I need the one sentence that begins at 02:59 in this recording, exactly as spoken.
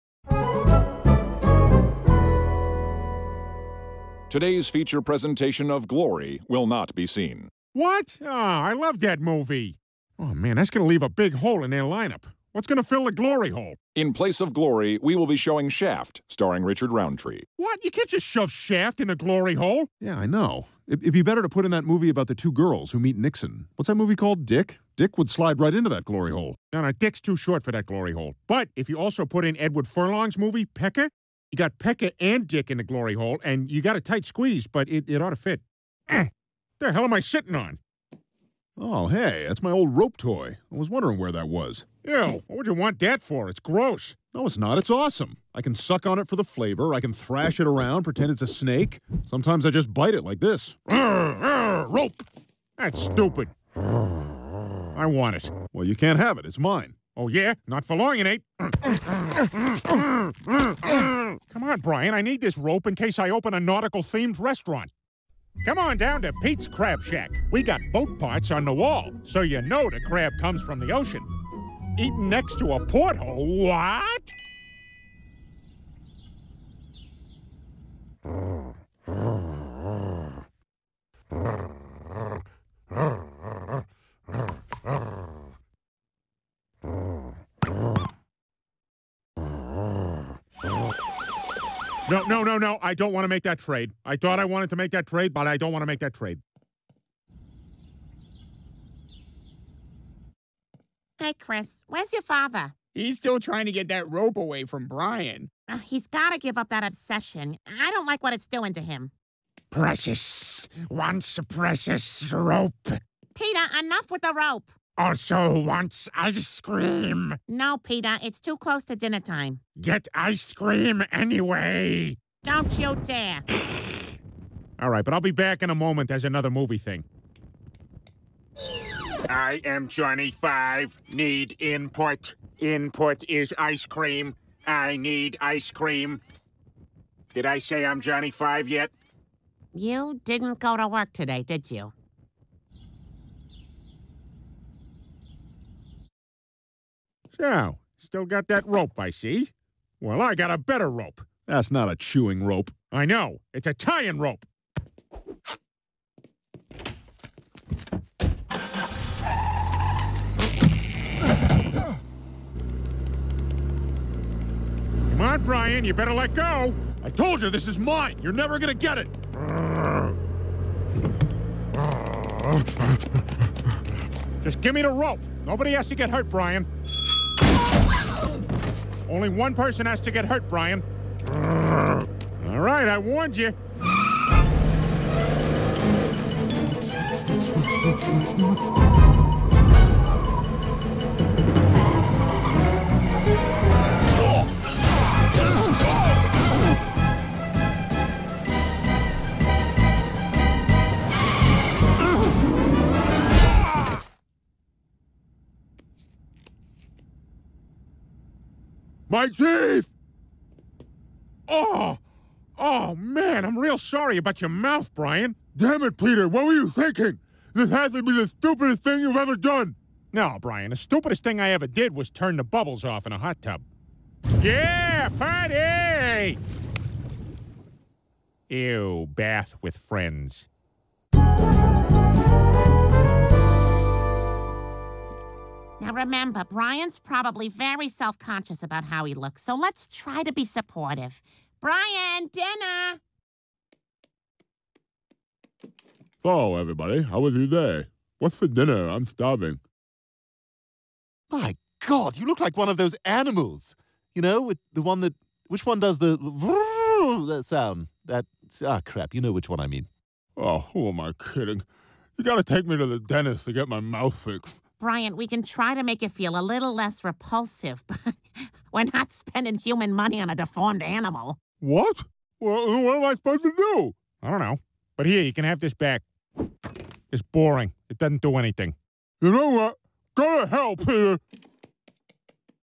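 Only one person has to get hurt, Brian.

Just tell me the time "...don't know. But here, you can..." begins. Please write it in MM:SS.
04:34.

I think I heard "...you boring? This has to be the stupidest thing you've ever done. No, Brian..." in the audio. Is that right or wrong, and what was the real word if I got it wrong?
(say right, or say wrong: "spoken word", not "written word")
wrong: "thinking", not "boring".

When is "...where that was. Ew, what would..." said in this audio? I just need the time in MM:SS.
00:41.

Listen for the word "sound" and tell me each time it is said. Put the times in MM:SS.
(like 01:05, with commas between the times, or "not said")
04:17.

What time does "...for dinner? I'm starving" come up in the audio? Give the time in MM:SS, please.
04:08.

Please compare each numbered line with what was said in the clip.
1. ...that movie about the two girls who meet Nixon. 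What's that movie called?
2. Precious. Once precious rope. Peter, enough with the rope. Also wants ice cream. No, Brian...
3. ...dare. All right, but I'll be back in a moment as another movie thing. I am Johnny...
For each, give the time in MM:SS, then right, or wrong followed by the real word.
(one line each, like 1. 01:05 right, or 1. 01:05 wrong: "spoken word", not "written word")
1. 00:21 right
2. 01:49 wrong: "Peter", not "Brian"
3. 02:03 right.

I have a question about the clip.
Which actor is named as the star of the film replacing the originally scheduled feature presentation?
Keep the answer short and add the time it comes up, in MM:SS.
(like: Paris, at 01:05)
Richard Roundtree, at 00:16.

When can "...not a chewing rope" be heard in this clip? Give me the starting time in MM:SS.
02:31.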